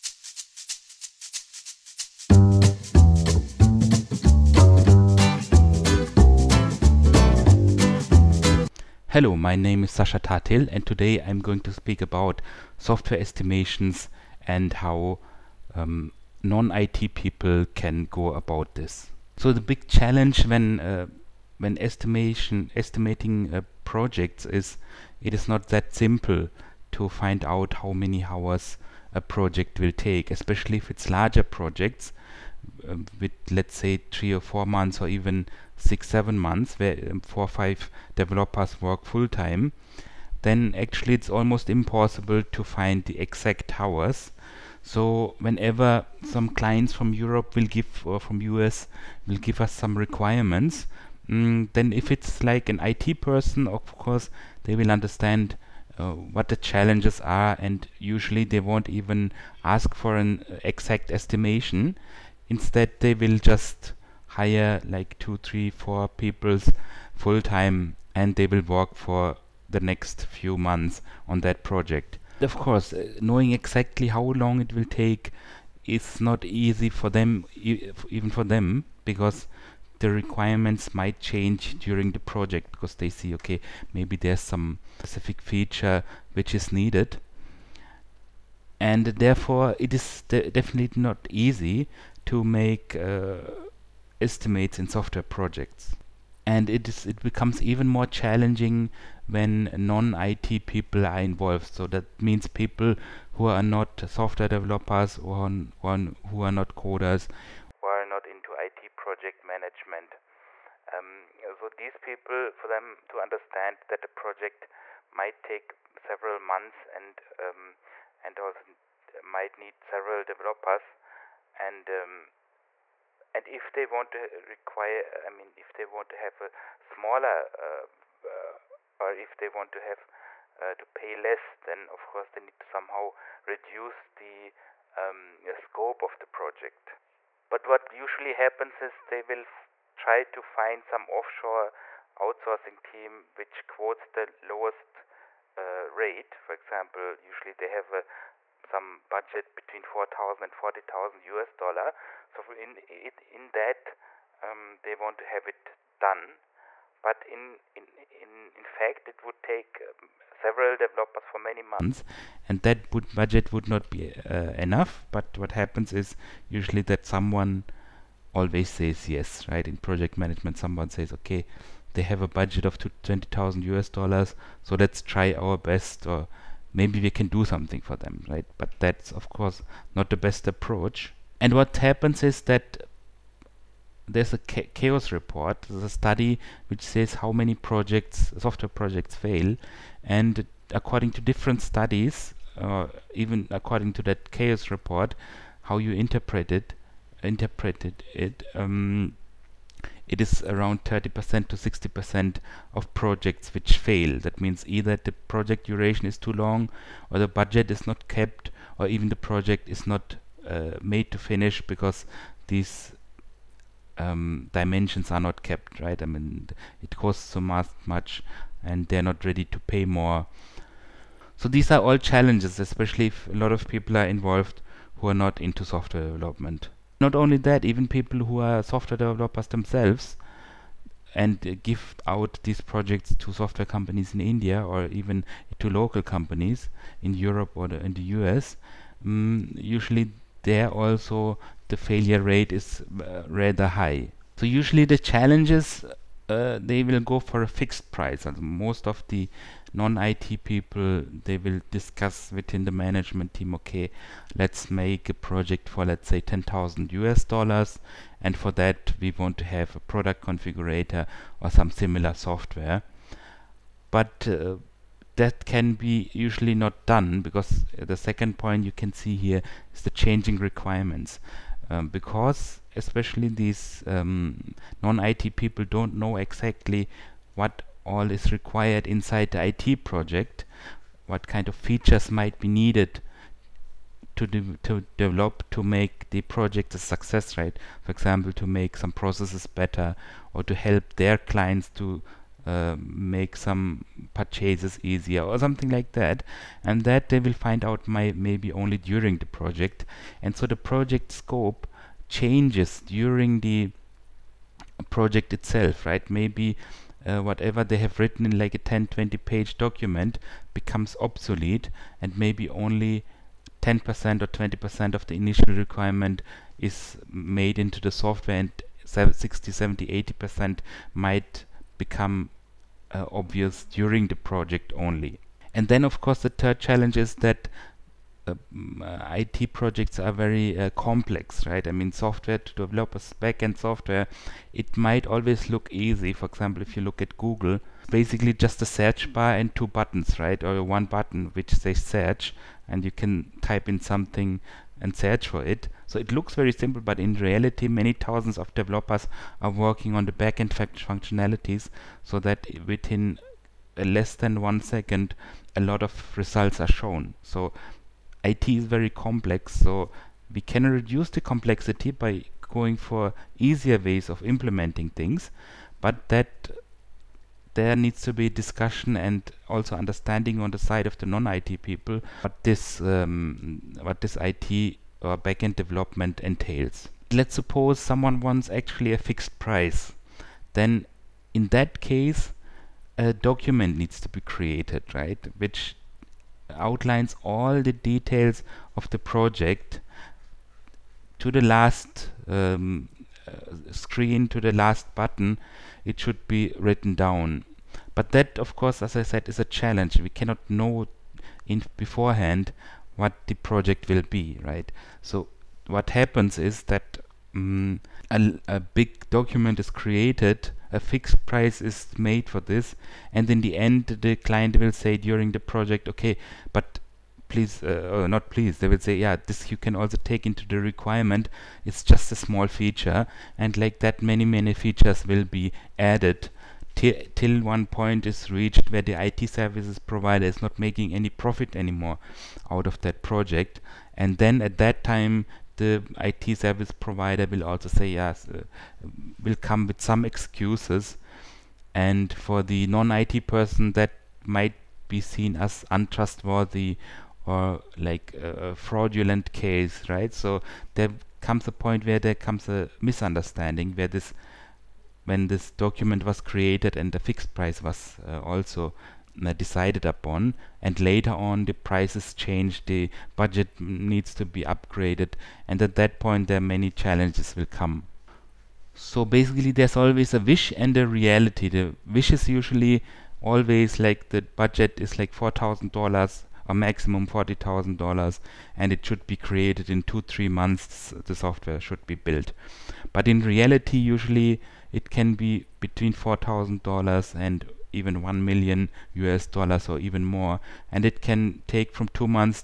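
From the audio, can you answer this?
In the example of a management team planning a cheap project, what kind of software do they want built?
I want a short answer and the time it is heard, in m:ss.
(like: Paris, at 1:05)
Product configurator, at 4:19.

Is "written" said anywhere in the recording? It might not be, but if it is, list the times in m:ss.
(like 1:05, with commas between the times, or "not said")
5:07, 6:36.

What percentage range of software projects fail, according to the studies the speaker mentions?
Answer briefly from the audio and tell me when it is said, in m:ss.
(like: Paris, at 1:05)
30% to 60%, at 3:20.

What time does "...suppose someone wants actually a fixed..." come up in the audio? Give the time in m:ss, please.
6:17.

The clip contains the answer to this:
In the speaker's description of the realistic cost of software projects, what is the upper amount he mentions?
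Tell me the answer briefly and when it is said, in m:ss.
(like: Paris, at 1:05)
$1 million, at 8:08.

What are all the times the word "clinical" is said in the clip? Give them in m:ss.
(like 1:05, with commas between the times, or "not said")
not said.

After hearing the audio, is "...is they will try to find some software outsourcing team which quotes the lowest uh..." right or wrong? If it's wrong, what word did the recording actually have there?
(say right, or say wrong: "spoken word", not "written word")
wrong: "offshore", not "software".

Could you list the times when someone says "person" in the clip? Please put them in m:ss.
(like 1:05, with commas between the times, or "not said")
0:53, 7:23.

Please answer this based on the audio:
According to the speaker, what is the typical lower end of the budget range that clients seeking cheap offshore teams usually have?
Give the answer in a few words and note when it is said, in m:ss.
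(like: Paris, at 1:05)
$4000, at 2:29.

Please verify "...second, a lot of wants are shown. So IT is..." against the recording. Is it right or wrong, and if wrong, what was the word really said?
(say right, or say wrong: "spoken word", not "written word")
wrong: "results", not "wants".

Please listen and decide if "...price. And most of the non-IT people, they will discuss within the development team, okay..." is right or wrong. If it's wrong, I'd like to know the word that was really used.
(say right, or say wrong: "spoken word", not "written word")
wrong: "management", not "development".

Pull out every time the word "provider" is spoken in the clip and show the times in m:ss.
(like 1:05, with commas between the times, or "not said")
7:09, 7:16.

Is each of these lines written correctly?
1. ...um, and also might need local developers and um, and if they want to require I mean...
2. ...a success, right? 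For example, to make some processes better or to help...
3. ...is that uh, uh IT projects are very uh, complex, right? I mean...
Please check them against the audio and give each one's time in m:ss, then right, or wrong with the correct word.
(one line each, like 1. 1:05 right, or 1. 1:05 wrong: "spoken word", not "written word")
1. 1:57 wrong: "several", not "local"
2. 4:46 right
3. 5:26 right.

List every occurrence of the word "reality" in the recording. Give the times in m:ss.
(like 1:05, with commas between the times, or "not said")
5:47, 7:50, 8:03.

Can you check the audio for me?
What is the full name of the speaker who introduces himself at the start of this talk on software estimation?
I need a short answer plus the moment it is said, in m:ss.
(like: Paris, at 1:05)
Sascha Thattil, at 0:09.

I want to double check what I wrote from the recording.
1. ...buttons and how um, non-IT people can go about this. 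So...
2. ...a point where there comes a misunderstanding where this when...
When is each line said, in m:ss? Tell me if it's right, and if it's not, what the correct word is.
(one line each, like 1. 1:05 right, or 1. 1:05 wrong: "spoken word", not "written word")
1. 0:13 wrong: "estimations", not "buttons"
2. 7:31 right.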